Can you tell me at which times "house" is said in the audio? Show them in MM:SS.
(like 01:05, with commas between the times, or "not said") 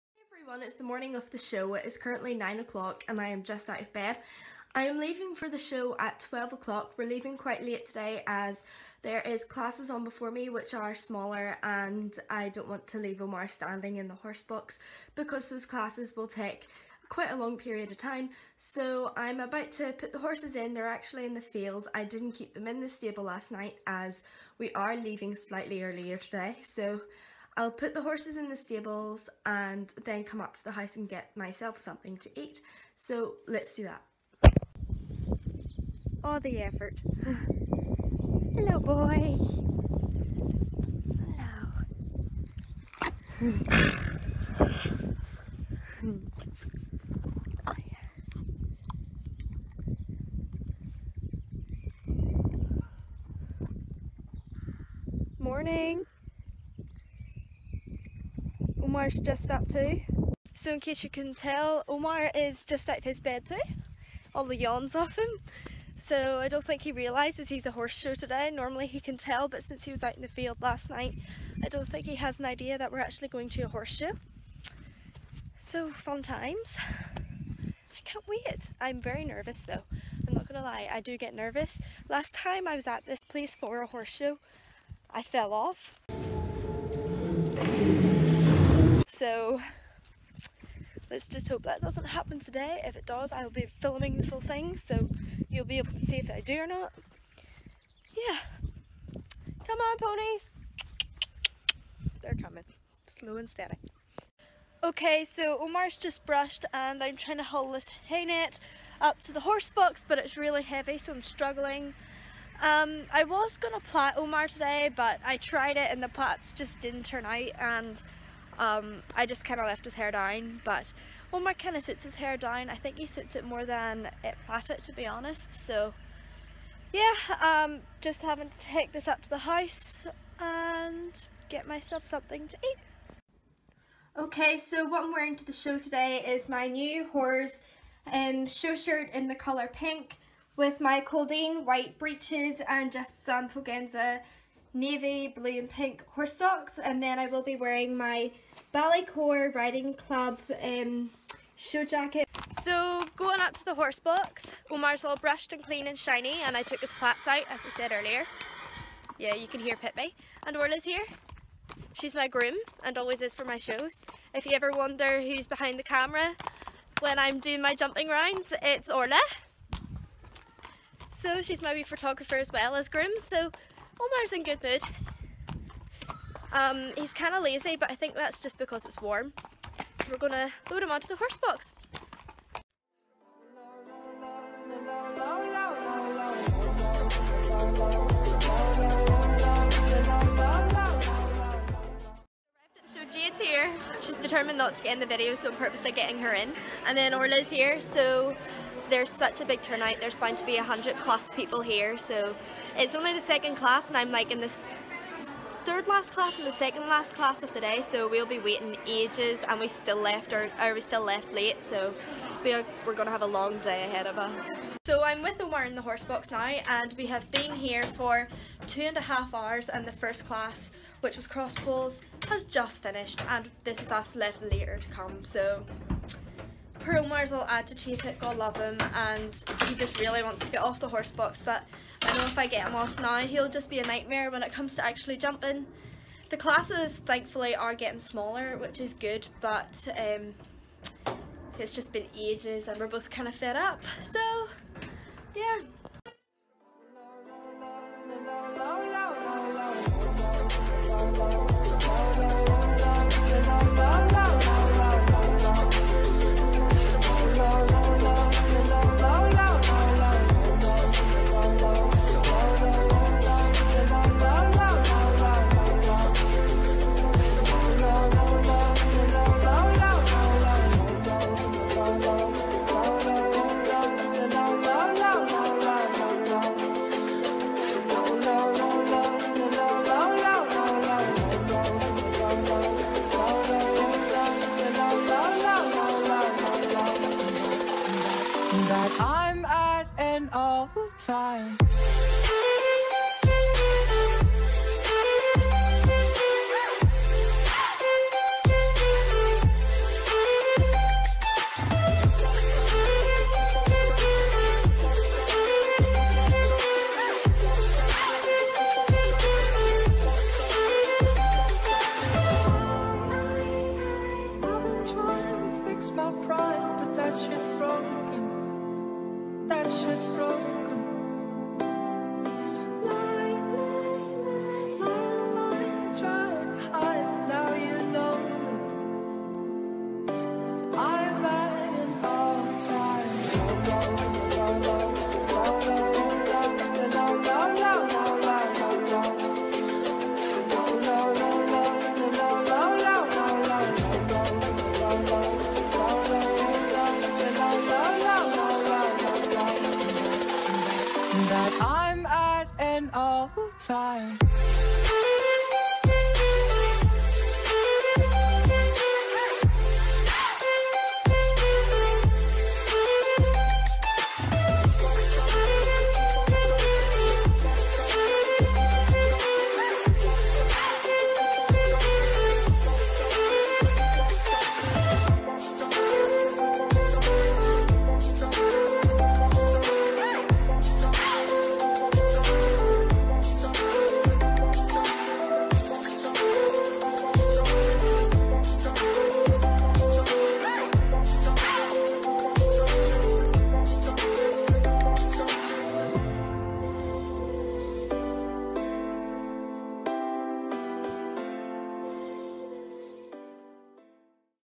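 00:30, 02:09.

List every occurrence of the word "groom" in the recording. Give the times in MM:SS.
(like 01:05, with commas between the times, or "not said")
02:42, 02:52.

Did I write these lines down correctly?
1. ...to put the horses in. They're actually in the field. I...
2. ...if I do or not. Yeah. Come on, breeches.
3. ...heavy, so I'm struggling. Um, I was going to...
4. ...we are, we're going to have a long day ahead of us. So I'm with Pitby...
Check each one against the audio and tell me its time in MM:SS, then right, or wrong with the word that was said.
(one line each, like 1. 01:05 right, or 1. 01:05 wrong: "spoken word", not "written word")
1. 00:19 right
2. 01:36 wrong: "ponies", not "breeches"
3. 01:50 right
4. 03:32 wrong: "Omar", not "Pitby".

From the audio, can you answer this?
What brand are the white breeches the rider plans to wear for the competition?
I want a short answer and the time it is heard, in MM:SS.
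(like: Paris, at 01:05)
Caldene, at 02:21.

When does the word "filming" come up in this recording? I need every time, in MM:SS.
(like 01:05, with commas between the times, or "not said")
01:33.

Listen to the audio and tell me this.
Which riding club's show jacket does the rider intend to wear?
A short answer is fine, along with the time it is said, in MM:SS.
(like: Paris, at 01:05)
Ballycore Riding Club, at 02:28.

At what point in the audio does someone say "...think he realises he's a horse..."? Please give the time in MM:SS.
01:06.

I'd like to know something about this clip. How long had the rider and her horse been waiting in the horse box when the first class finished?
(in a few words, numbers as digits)
two and a half hours.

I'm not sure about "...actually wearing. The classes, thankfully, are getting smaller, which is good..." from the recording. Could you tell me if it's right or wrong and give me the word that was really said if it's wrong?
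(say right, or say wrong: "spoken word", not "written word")
wrong: "jumping", not "wearing".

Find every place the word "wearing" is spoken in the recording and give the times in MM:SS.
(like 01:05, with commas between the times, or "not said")
02:15, 02:27.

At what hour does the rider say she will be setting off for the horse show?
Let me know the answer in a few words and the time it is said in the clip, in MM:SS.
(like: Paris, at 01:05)
12 o'clock, at 00:06.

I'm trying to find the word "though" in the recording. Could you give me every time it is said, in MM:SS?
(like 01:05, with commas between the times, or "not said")
01:19.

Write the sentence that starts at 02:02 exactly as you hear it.
I think he suits it more than it flat to be honest.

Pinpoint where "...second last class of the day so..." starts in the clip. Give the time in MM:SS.
03:26.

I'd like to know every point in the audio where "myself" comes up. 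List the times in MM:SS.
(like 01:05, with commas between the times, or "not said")
00:31, 02:11.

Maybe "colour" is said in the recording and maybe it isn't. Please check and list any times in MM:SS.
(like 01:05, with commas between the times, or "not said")
02:19.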